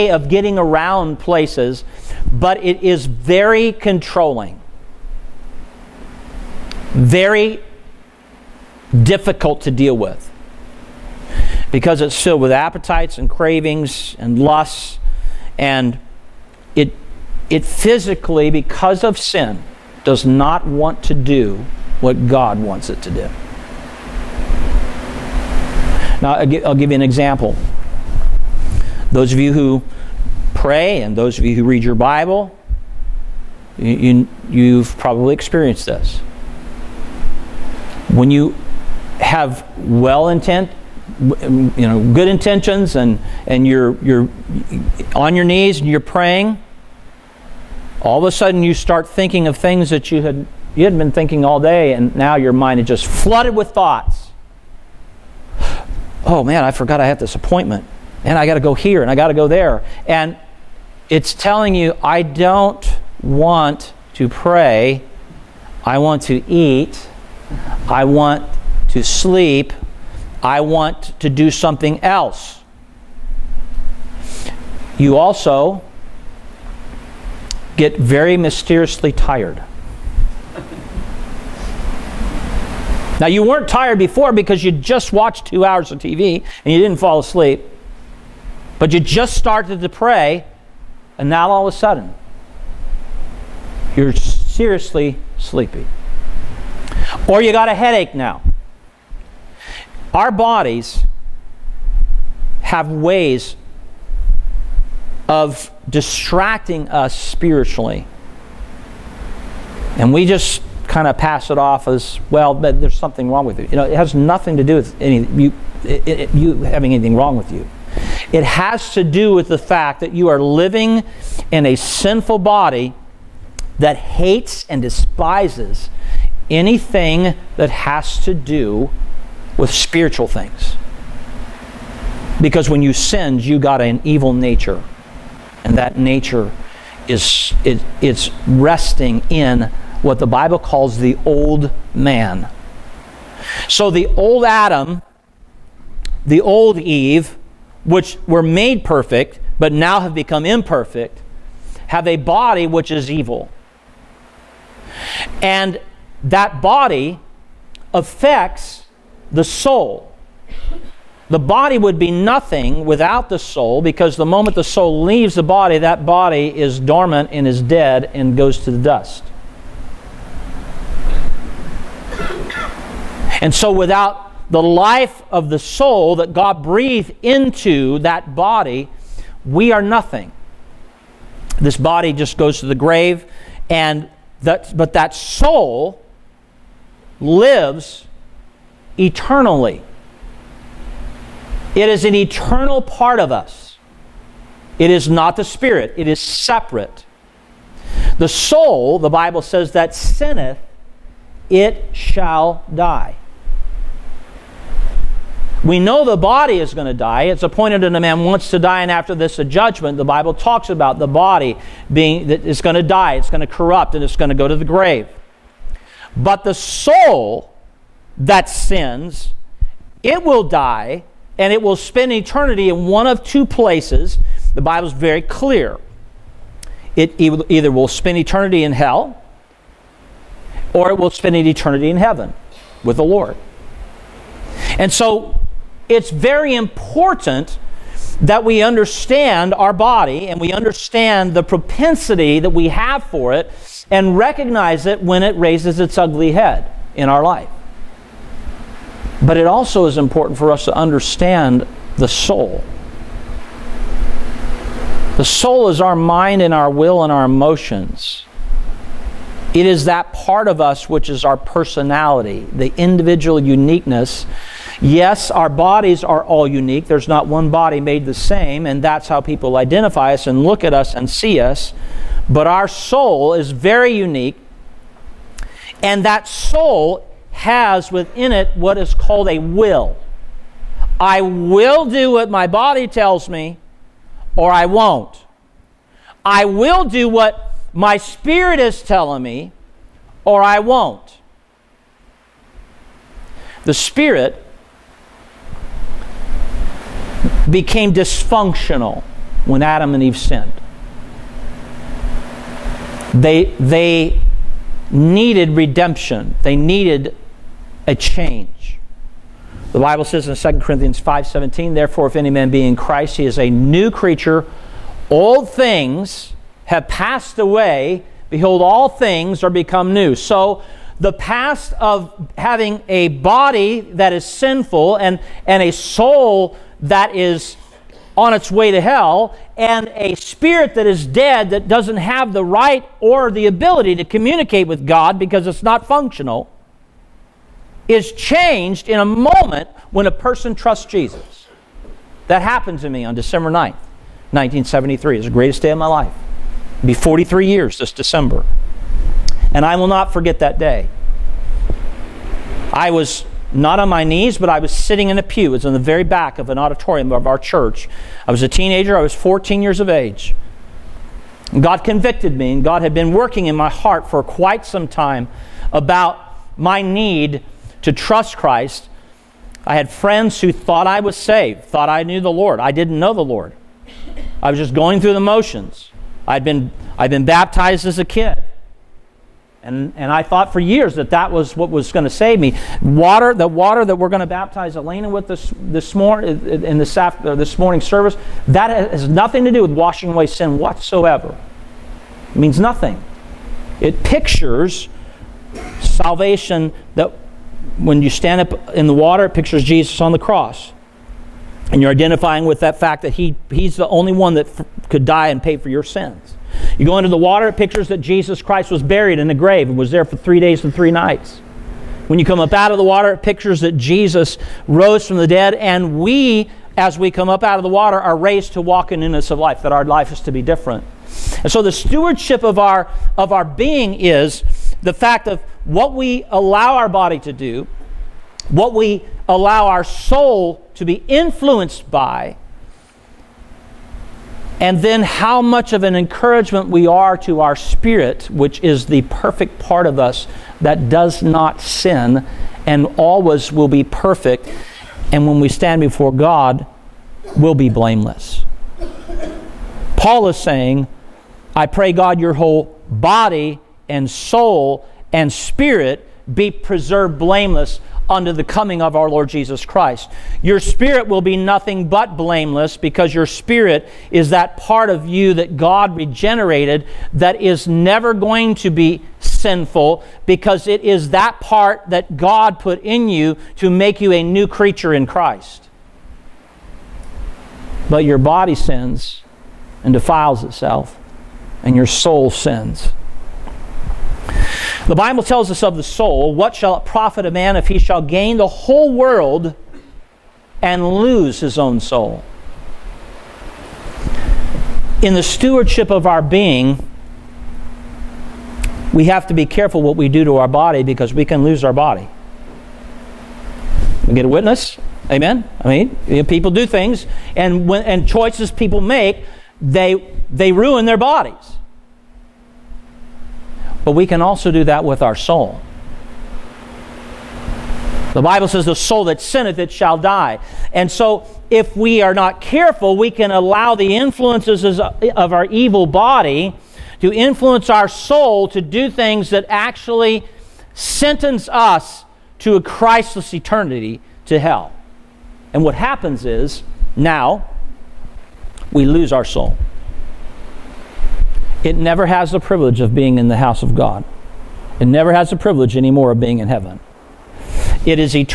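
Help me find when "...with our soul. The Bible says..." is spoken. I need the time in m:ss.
8:34.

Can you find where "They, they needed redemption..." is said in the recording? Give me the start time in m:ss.
5:03.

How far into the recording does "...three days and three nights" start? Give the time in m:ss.
6:50.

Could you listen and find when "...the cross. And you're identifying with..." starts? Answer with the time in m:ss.
6:40.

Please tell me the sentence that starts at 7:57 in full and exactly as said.
But your body sins and defiles itself, and your soul sins.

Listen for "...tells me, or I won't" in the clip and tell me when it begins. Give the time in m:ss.
4:42.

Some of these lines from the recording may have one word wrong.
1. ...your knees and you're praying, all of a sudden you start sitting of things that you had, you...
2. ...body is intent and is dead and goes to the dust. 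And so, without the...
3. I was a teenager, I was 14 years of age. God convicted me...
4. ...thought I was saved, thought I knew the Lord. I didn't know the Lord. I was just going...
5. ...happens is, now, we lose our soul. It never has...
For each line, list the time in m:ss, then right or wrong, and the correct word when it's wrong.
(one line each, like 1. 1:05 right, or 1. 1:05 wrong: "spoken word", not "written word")
1. 0:45 wrong: "thinking", not "sitting"
2. 2:46 wrong: "dormant", not "intent"
3. 5:58 right
4. 6:10 right
5. 8:55 right.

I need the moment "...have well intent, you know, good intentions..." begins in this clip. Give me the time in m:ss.
0:39.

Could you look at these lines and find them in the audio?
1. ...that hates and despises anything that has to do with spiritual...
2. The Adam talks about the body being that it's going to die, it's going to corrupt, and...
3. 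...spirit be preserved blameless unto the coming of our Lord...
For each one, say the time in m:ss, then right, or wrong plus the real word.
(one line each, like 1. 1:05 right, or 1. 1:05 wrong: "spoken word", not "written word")
1. 2:03 right
2. 3:29 wrong: "Bible", not "Adam"
3. 7:35 right.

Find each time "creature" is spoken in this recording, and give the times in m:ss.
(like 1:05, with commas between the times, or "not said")
5:13, 7:54.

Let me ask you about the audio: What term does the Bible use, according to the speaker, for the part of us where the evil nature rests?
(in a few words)
the old man.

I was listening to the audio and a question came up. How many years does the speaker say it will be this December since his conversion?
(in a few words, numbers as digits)
43.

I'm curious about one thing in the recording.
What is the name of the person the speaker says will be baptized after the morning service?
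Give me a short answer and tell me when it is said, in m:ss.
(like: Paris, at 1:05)
Elena, at 6:24.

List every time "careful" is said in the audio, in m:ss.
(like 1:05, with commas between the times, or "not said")
8:19, 8:42.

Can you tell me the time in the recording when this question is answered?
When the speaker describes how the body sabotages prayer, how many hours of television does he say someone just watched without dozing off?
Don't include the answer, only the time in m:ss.
1:25.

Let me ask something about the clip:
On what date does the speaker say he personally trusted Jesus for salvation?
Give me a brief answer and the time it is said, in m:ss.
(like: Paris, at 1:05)
December 9th, 1973, at 5:43.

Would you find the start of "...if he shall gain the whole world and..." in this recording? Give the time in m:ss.
8:07.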